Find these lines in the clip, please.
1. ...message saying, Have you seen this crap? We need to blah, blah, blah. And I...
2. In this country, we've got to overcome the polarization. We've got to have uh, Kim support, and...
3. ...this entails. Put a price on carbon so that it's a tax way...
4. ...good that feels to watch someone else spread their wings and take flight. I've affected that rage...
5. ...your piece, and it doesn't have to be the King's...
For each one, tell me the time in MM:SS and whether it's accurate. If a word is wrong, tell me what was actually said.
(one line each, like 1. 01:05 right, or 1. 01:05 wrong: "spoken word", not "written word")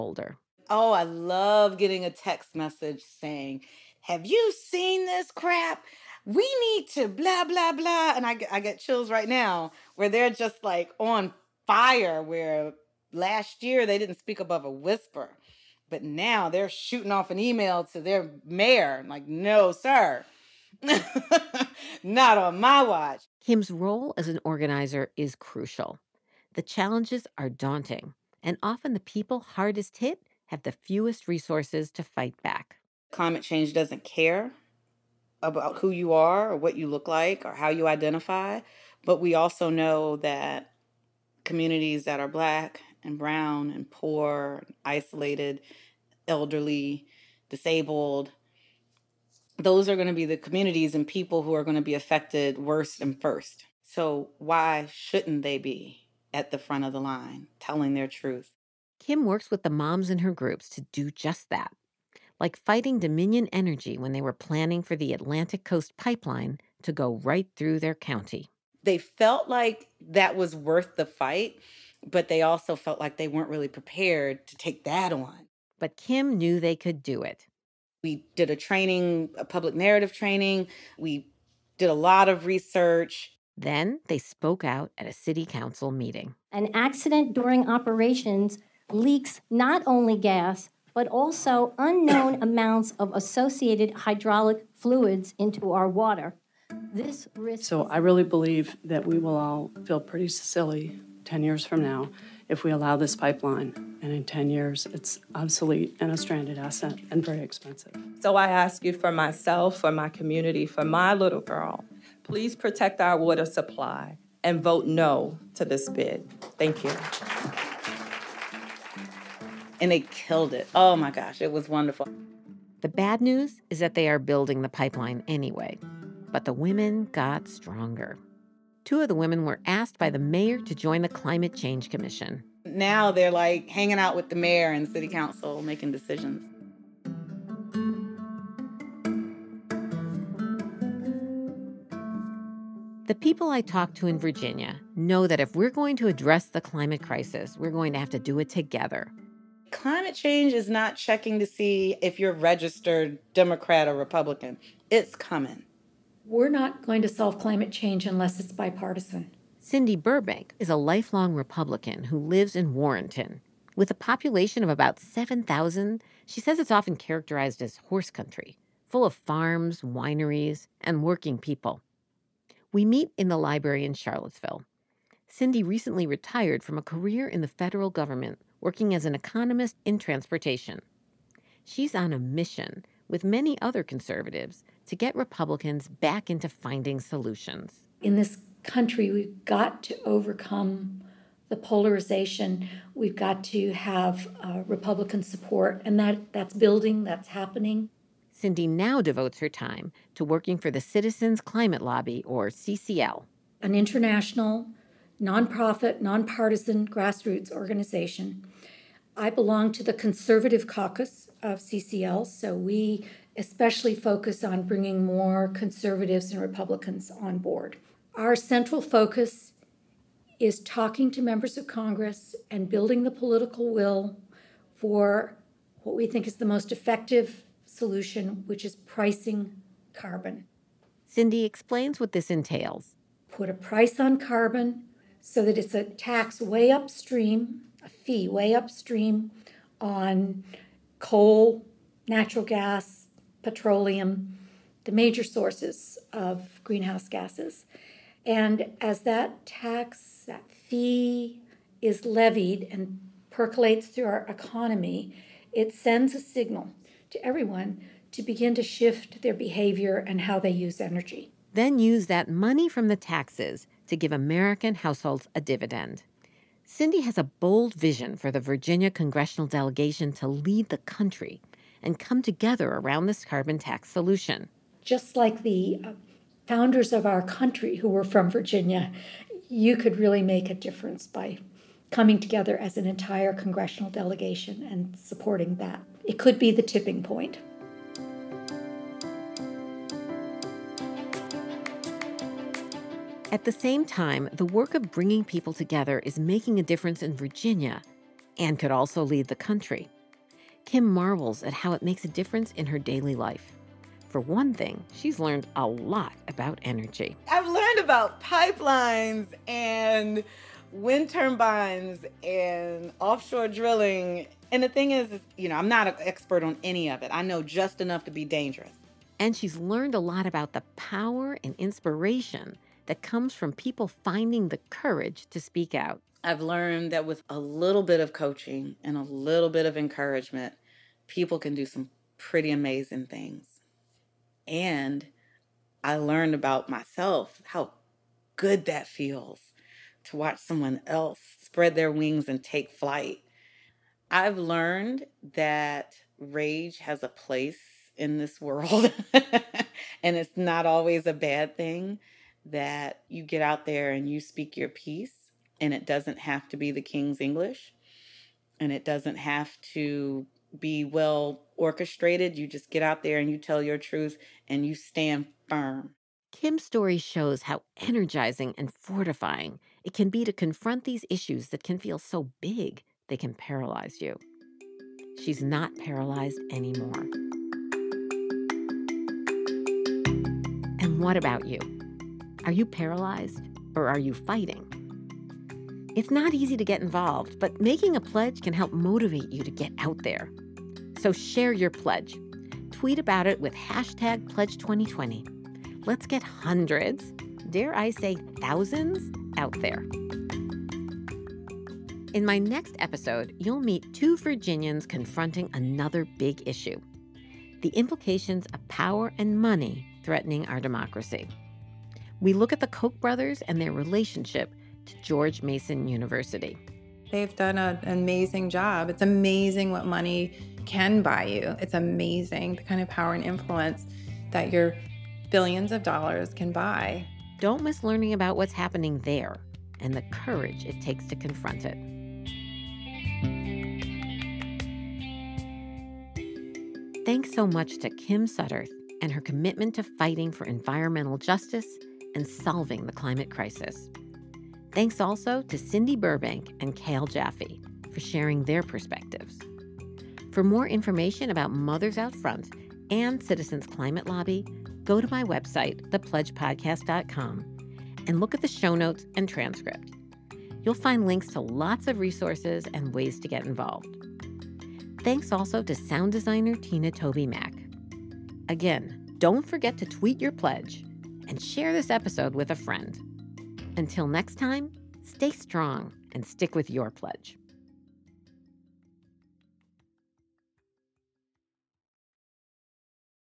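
1. 00:02 right
2. 03:08 wrong: "Republican", not "Kim"
3. 03:52 right
4. 05:38 wrong: "learned", not "affected"
5. 05:54 right.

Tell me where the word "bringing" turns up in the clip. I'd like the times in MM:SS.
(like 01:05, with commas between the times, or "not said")
03:34, 04:54.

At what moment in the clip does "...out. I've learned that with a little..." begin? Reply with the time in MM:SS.
05:25.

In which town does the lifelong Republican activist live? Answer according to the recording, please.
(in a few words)
Warrenton.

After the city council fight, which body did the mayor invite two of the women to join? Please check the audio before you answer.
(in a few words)
Climate Change Commission.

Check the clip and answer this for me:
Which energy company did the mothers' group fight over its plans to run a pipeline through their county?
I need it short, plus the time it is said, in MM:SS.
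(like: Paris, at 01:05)
Dominion Energy, at 01:02.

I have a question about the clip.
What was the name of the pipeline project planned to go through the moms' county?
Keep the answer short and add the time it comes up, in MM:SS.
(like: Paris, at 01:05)
Atlantic Coast Pipeline, at 01:05.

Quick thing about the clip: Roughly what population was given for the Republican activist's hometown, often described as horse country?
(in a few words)
7,000.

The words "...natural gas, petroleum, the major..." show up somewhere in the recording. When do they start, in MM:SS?
04:02.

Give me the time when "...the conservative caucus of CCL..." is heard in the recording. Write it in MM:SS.
03:29.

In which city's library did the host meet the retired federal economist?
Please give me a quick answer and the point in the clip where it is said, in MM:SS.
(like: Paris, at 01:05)
Charlottesville, at 02:53.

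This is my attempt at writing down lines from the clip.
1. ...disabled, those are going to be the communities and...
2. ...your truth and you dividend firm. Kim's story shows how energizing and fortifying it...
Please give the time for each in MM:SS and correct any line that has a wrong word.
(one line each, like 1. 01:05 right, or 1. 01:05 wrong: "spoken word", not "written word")
1. 00:47 right
2. 06:03 wrong: "stand", not "dividend".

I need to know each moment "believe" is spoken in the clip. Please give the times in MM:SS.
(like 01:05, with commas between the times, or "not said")
01:38.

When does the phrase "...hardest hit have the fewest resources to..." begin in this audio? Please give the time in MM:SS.
00:29.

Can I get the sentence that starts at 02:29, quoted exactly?
Climate change is not checking to see if you're registered Democrat or Republican.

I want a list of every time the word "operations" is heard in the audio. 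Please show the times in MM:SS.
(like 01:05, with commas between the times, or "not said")
01:27.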